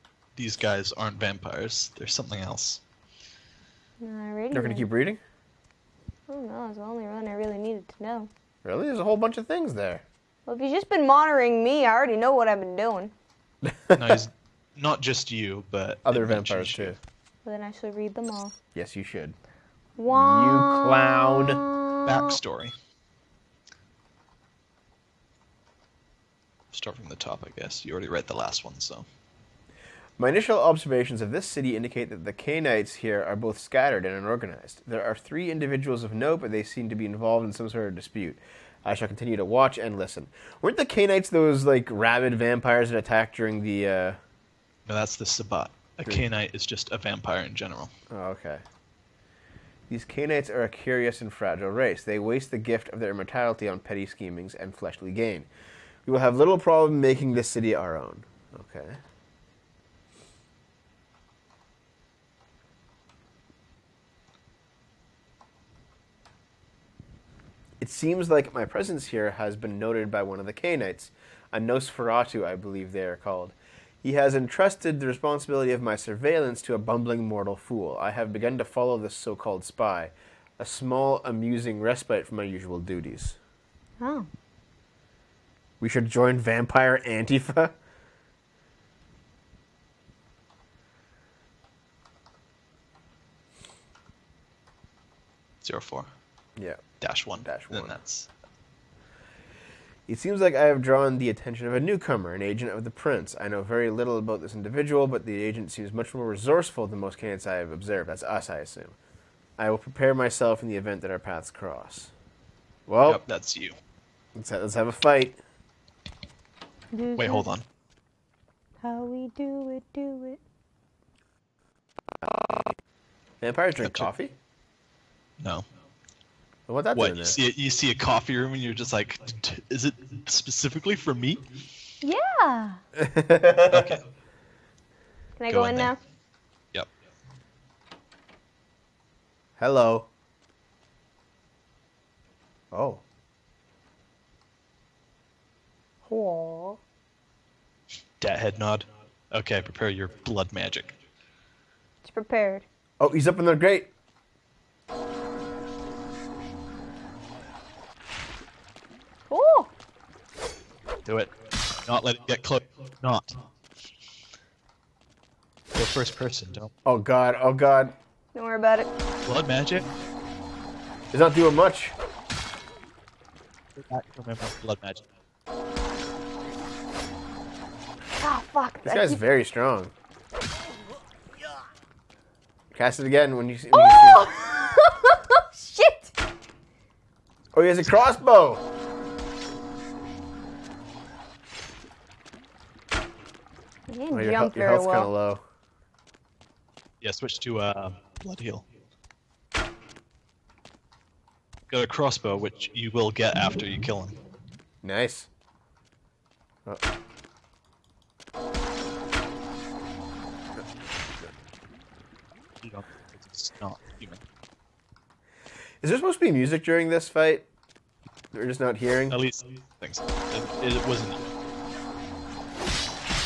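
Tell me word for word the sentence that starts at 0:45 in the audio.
A Cainite canite is just a vampire in general.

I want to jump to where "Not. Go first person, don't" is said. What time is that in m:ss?
2:43.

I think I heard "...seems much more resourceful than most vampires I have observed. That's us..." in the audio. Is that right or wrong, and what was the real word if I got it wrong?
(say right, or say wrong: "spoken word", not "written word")
wrong: "candidates", not "vampires".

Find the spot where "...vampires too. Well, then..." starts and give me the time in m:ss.
0:16.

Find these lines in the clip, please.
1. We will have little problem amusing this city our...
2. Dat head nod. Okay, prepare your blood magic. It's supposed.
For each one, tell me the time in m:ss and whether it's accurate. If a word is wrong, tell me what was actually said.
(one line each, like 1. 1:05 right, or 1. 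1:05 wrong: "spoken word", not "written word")
1. 0:56 wrong: "making", not "amusing"
2. 2:28 wrong: "prepared", not "supposed".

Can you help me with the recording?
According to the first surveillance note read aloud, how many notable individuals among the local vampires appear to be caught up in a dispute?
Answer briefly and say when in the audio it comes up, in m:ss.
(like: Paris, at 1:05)
3, at 0:35.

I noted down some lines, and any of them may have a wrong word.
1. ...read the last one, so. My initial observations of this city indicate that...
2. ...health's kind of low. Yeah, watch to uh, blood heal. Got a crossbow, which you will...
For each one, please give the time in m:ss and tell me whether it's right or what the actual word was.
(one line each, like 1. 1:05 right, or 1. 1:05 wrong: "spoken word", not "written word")
1. 0:28 right
2. 3:14 wrong: "switch", not "watch".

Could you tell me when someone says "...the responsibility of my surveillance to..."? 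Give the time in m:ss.
1:14.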